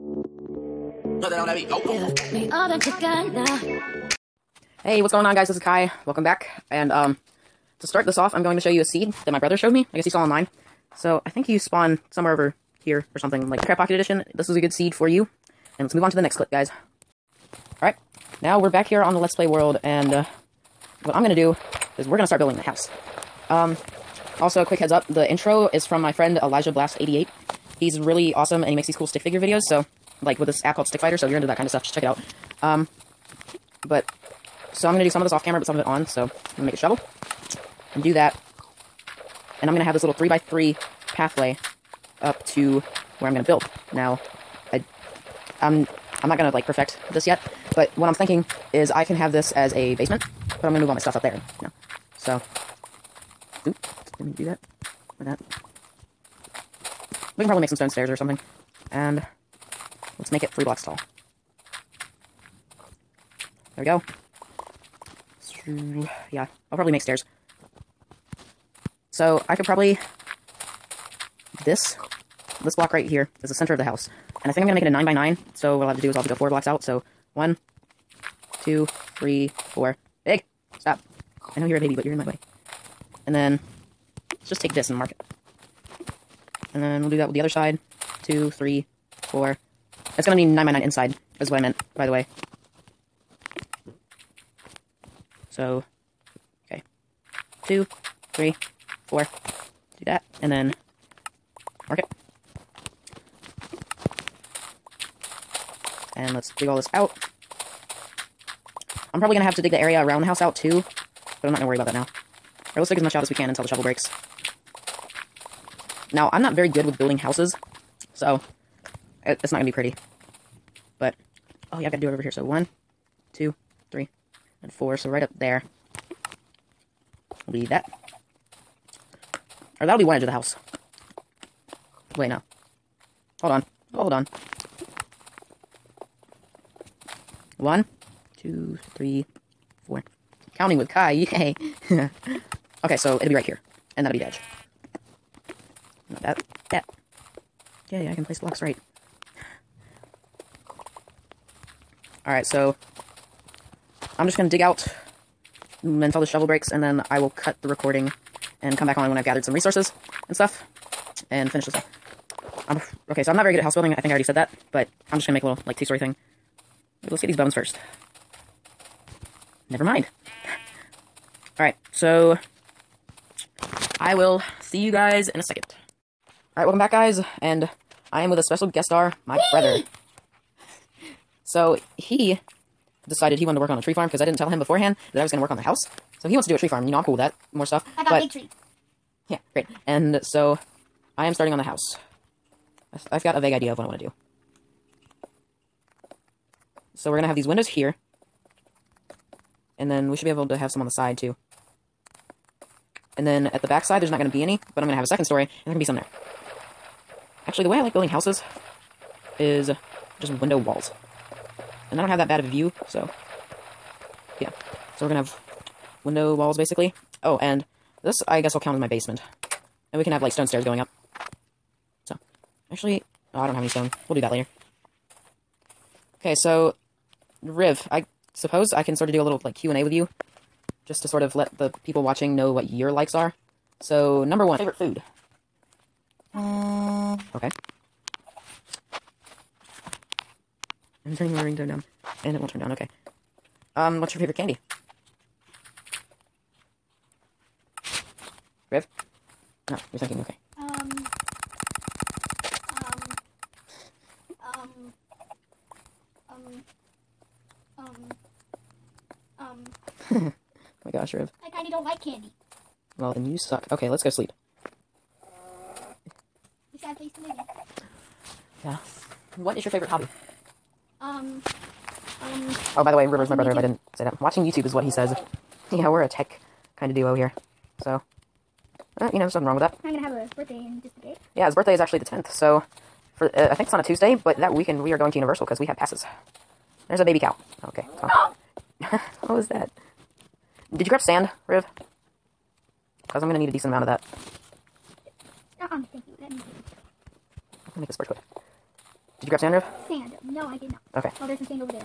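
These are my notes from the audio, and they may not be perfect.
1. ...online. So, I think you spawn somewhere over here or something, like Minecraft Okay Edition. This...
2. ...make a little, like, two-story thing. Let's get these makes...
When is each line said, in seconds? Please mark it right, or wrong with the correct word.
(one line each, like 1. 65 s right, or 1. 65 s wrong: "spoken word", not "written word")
1. 10 s wrong: "Pocket", not "Okay"
2. 165 s wrong: "bones", not "makes".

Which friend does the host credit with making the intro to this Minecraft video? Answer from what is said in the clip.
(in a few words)
Elijah Blast88.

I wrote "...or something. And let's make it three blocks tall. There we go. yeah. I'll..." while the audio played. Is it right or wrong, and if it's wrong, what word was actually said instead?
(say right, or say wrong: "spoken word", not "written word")
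right.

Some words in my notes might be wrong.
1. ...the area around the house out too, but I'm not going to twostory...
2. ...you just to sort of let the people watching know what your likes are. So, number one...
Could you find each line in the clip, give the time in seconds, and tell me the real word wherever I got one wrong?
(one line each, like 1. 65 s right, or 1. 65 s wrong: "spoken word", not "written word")
1. 109 s wrong: "worry", not "twostory"
2. 229 s right.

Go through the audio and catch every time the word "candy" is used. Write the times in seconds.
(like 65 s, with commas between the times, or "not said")
244 s, 262 s.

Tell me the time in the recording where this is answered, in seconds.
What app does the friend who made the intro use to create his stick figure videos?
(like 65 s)
30 s.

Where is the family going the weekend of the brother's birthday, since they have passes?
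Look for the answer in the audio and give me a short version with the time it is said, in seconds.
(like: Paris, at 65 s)
Universal, at 285 s.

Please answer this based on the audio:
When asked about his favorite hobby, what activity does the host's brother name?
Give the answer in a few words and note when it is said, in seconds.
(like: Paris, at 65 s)
Watching YouTube, at 274 s.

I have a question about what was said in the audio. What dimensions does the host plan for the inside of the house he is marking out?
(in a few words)
9 by 9.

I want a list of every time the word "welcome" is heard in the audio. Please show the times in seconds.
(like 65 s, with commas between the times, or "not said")
6 s, 176 s.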